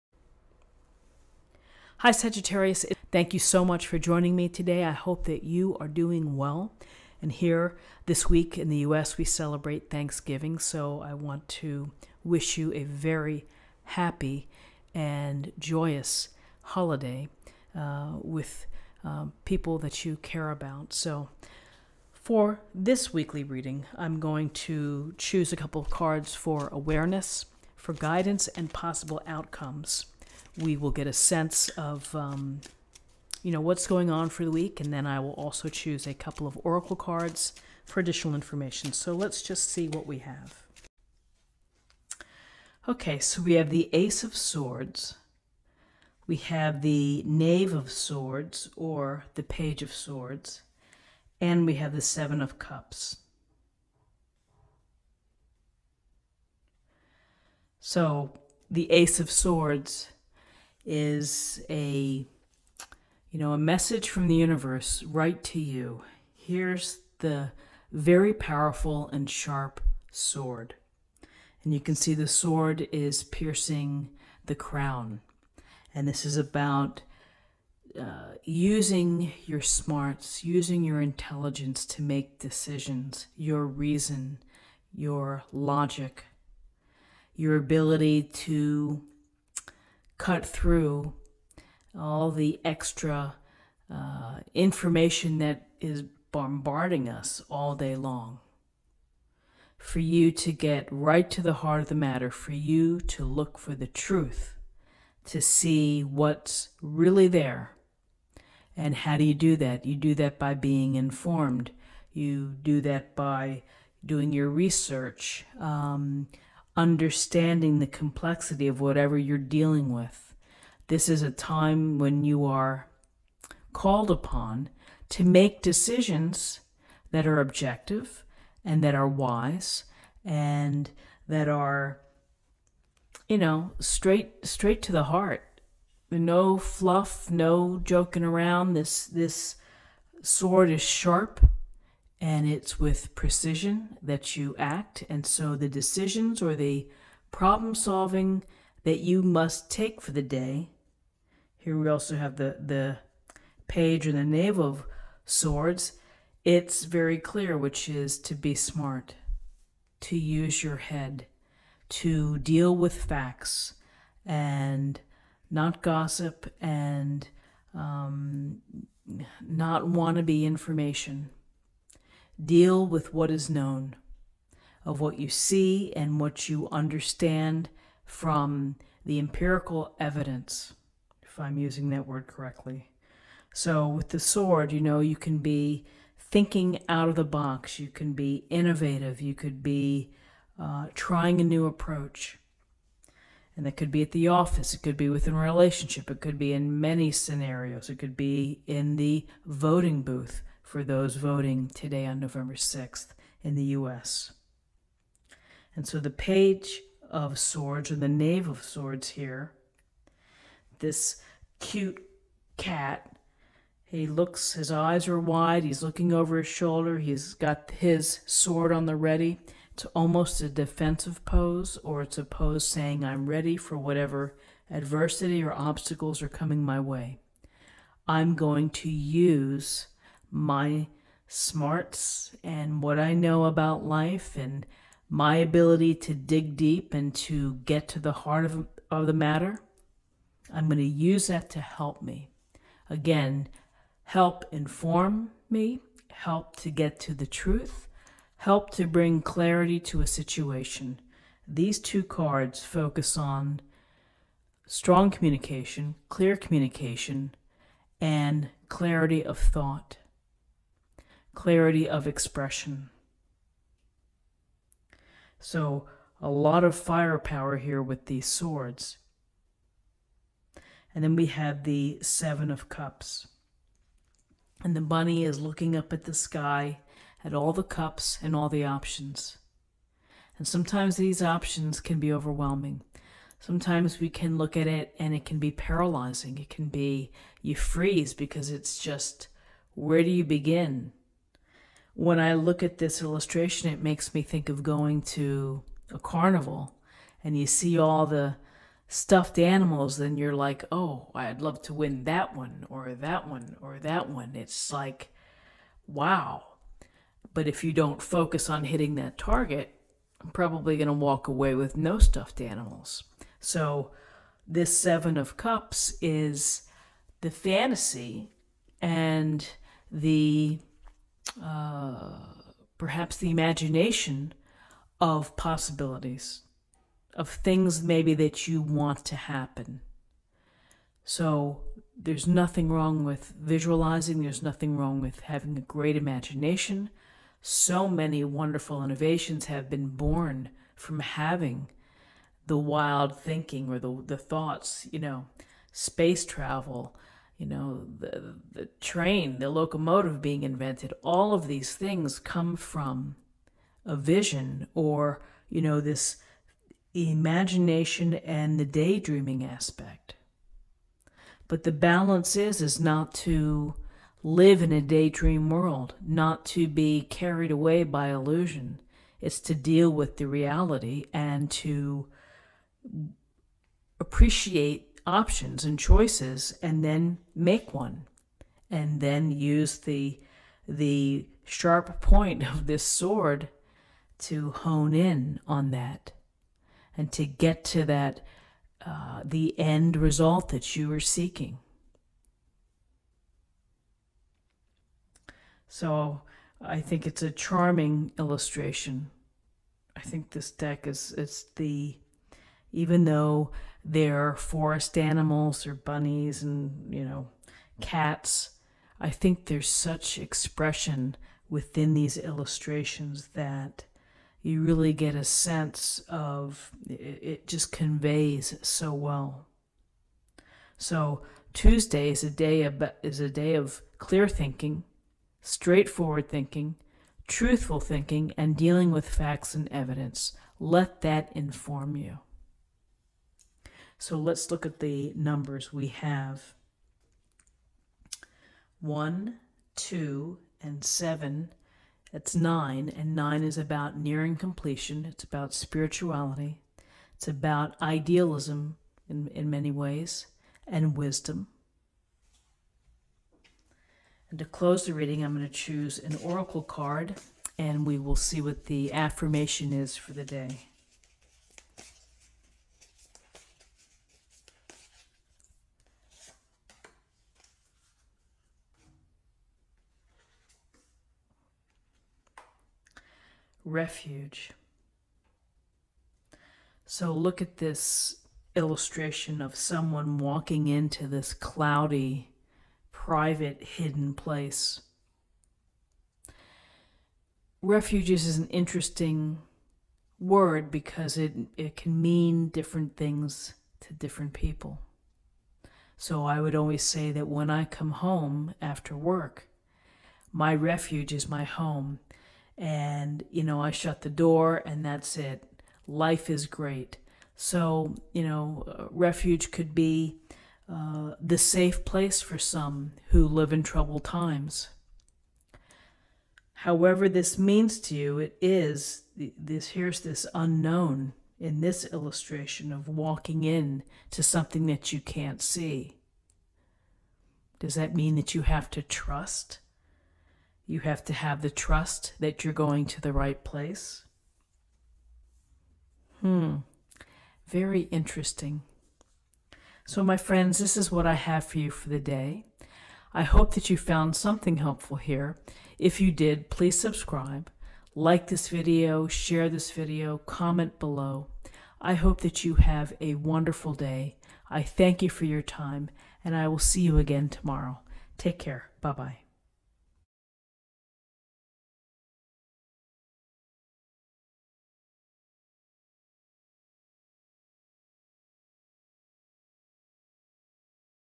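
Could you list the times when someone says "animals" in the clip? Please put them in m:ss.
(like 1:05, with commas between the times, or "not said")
4:59, 5:12, 6:44.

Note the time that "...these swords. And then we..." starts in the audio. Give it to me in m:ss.
4:28.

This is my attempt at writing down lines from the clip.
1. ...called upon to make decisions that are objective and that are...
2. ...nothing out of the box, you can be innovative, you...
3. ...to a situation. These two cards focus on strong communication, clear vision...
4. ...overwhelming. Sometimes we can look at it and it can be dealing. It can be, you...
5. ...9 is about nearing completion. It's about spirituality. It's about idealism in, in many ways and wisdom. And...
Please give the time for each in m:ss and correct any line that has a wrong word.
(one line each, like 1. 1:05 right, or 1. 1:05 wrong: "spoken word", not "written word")
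1. 2:03 right
2. 3:06 wrong: "thinking", not "nothing"
3. 4:09 wrong: "communication", not "vision"
4. 4:42 wrong: "paralyzing", not "dealing"
5. 7:23 right.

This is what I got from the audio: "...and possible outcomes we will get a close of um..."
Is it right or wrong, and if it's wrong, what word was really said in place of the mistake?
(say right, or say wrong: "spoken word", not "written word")
wrong: "sense", not "close".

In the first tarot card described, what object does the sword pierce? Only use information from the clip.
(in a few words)
The crown.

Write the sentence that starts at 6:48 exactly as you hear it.
I think there's such expression within these illustrations that you really get a sense of it, just conveys so well.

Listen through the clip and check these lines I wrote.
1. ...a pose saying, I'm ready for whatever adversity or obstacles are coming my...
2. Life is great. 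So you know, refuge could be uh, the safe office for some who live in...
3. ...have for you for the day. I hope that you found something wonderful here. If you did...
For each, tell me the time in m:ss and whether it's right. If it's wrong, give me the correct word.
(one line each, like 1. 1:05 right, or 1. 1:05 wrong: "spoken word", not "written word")
1. 3:42 right
2. 8:25 wrong: "place", not "office"
3. 9:01 wrong: "helpful", not "wonderful".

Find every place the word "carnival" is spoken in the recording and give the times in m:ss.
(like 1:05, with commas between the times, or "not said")
4:55.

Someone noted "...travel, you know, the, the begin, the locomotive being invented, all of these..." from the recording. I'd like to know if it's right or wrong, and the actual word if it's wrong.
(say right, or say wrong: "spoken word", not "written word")
wrong: "train", not "begin".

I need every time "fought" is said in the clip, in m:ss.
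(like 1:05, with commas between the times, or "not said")
not said.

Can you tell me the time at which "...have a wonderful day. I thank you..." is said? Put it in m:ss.
9:12.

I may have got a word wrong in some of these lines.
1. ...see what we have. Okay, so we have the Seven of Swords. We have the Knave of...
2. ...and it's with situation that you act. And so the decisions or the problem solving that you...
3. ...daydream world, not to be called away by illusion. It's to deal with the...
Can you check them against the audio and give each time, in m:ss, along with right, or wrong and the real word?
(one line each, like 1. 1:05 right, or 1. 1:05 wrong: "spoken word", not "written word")
1. 0:39 wrong: "Ace", not "Seven"
2. 2:22 wrong: "precision", not "situation"
3. 6:04 wrong: "carried", not "called".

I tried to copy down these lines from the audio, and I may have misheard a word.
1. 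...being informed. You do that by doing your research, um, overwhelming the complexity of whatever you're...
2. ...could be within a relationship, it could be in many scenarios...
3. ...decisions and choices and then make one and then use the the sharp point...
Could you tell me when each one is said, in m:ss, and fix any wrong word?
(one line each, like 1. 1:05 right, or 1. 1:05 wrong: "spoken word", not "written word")
1. 1:50 wrong: "understanding", not "overwhelming"
2. 3:14 right
3. 6:15 wrong: "options", not "decisions".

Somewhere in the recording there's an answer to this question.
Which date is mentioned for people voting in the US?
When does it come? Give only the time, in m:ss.
3:22.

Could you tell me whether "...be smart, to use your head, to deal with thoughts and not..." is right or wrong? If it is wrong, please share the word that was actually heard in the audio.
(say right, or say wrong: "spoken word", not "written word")
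wrong: "facts", not "thoughts".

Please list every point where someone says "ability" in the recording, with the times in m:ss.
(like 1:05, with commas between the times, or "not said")
1:27, 3:55.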